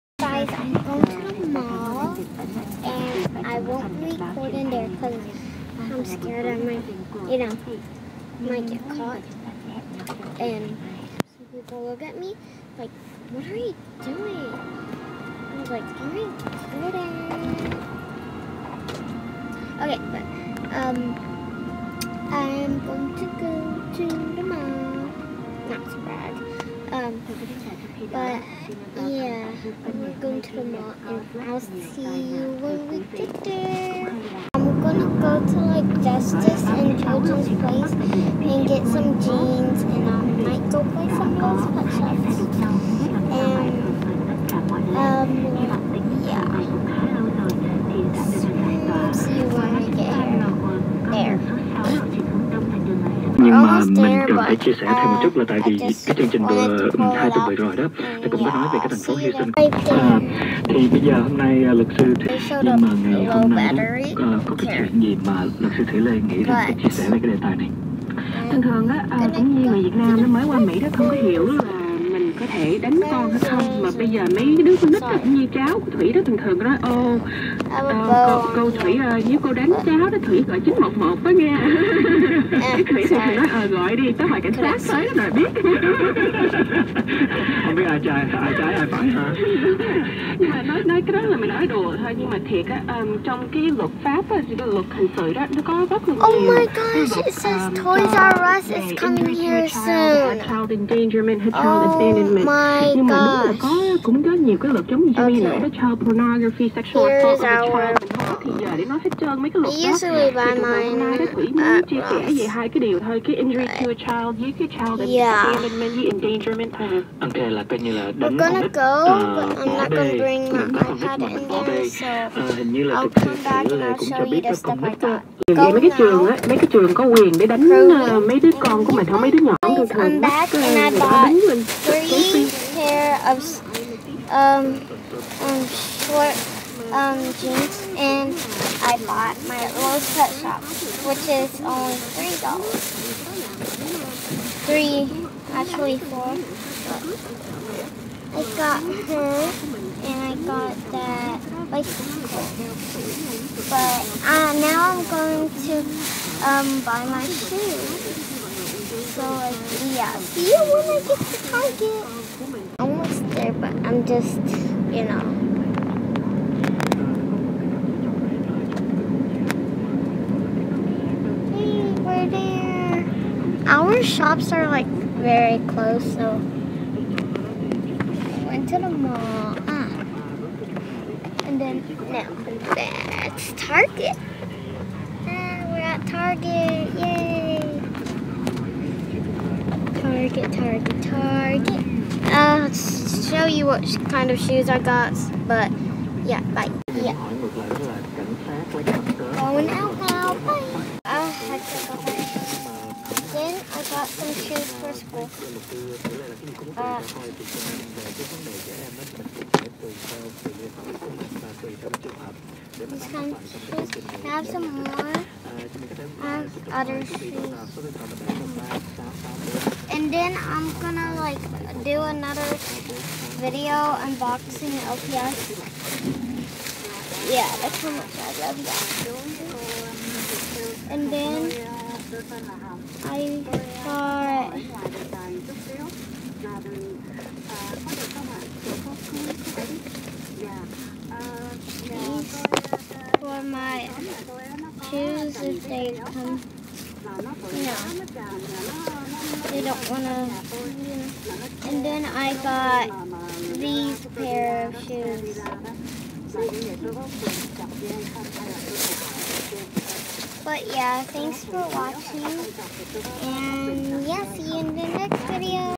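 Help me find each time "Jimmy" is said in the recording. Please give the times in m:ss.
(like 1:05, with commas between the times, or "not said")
1:45.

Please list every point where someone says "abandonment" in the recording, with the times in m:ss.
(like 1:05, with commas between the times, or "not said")
1:41, 1:55.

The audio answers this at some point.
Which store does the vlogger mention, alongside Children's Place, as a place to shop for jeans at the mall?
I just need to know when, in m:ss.
0:36.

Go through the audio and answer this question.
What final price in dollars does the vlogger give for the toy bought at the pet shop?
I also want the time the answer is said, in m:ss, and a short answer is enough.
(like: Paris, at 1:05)
4, at 2:25.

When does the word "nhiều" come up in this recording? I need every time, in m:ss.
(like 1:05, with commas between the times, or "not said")
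1:36, 1:44.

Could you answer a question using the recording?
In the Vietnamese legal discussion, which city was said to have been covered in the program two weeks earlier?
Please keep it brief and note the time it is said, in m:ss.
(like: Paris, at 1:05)
Houston, at 0:59.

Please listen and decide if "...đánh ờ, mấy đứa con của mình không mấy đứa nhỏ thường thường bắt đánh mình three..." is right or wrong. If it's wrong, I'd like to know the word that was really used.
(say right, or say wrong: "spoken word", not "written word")
right.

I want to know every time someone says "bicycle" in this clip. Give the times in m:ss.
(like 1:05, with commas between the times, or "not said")
2:31.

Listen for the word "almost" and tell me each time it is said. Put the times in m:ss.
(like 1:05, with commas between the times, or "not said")
0:53, 2:42.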